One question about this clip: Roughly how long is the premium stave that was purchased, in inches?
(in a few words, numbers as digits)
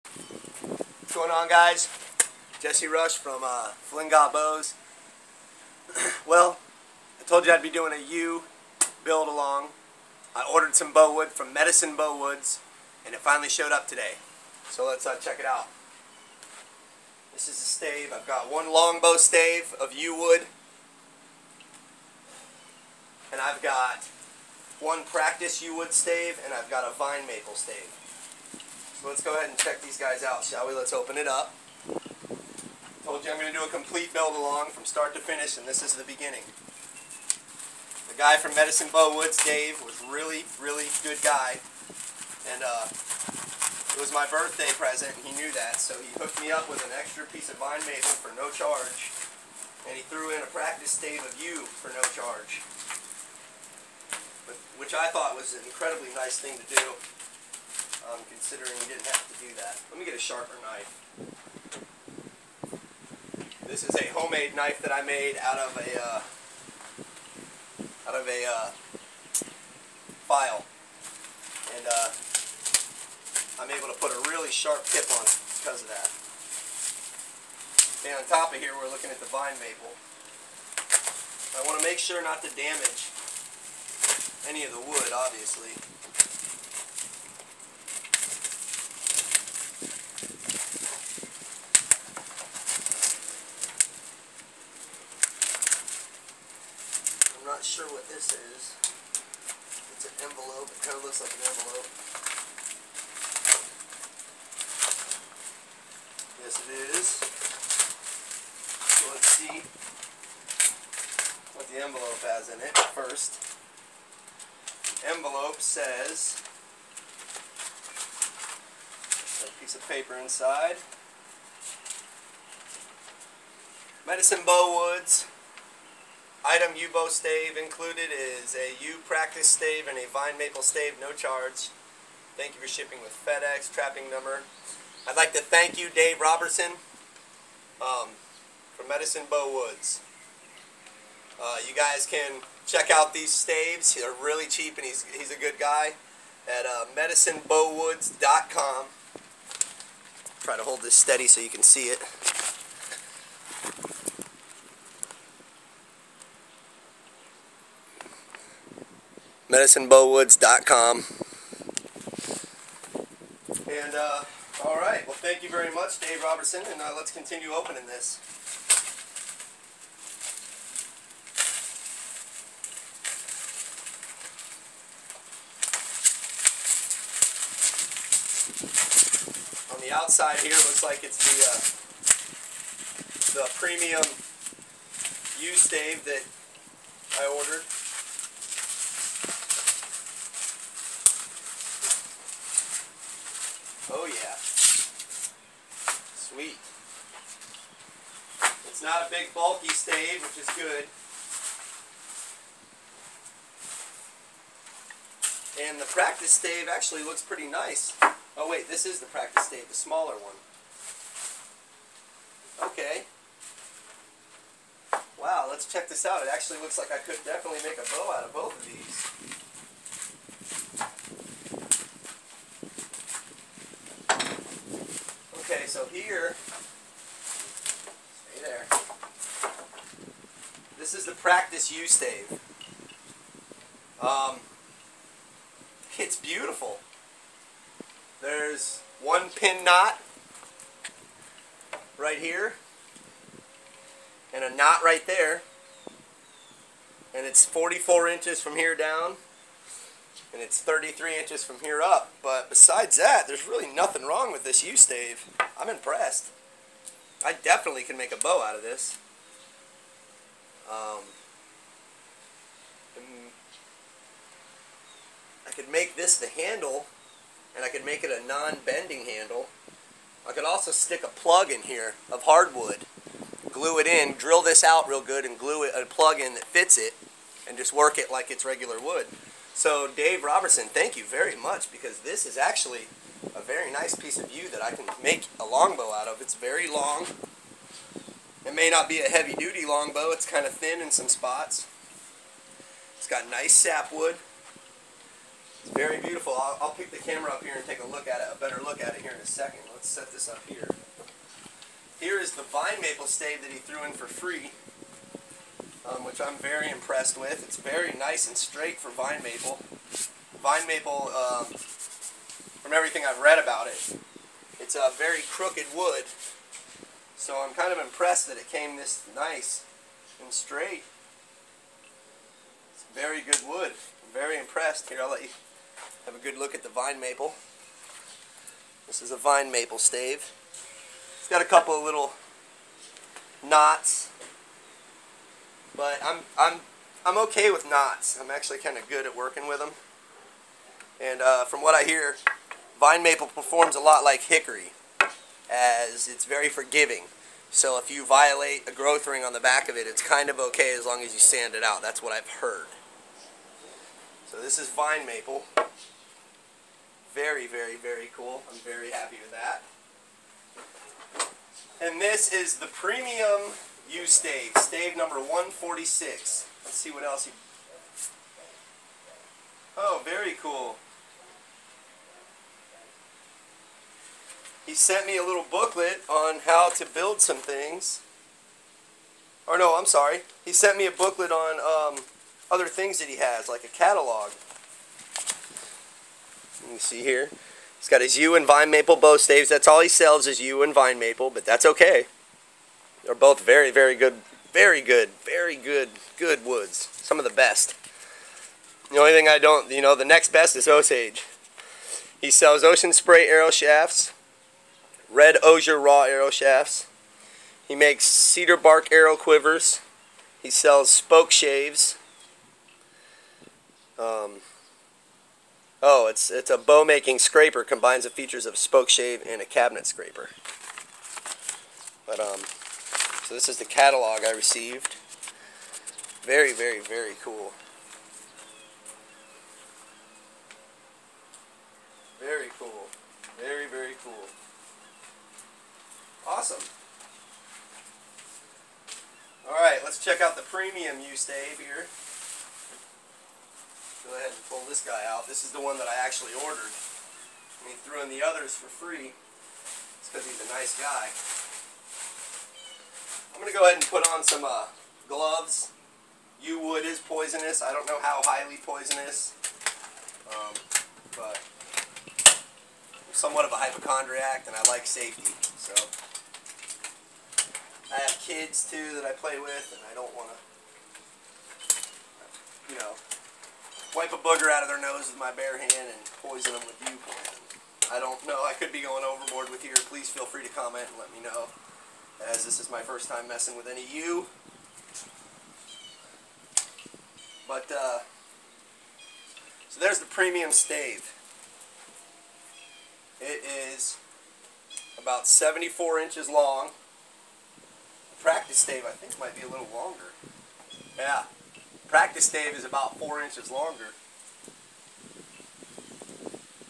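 74 inches.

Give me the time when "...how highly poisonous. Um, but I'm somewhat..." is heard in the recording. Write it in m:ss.
7:38.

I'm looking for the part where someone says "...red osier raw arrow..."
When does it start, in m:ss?
6:45.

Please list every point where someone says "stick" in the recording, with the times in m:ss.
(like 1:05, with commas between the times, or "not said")
4:30.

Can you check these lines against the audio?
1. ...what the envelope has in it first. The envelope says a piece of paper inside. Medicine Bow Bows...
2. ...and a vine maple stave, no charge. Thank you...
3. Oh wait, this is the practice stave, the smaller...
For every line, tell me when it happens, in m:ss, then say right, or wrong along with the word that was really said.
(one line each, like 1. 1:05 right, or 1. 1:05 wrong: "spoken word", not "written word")
1. 1:51 wrong: "Woods", not "Bows"
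2. 2:09 right
3. 3:28 right.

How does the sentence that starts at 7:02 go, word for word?
But, um, so this is the catalog I received.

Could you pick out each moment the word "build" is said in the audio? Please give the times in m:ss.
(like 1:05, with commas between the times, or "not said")
0:09, 0:34, 6:16.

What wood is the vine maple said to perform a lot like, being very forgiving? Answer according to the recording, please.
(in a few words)
Hickory.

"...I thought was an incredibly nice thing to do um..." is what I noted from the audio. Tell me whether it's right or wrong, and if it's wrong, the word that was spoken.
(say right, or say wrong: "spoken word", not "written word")
right.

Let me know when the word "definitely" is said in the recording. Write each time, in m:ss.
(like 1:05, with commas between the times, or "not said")
3:37, 4:17.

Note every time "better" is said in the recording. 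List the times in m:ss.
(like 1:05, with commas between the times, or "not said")
4:58.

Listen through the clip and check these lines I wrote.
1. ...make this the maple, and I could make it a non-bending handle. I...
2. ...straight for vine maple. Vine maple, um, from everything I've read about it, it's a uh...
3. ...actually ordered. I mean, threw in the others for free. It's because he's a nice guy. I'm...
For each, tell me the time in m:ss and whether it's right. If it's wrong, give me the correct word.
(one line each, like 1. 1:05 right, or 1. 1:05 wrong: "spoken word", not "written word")
1. 4:25 wrong: "handle", not "maple"
2. 5:08 right
3. 7:26 right.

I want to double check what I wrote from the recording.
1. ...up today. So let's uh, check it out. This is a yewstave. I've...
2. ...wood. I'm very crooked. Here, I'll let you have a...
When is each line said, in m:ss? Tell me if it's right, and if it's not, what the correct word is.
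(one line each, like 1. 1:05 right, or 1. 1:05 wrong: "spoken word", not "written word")
1. 0:13 wrong: "stave", not "yewstave"
2. 5:23 wrong: "impressed", not "crooked".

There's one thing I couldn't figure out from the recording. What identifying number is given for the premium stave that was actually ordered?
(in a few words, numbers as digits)
146.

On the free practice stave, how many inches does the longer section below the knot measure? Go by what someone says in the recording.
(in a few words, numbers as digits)
44 inches.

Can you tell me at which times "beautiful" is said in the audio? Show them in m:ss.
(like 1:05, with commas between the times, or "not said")
3:56, 4:55.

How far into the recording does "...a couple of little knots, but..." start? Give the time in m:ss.
5:31.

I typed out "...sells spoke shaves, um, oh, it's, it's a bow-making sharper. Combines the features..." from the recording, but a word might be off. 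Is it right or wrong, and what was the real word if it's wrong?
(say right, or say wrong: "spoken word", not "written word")
wrong: "scraper", not "sharper".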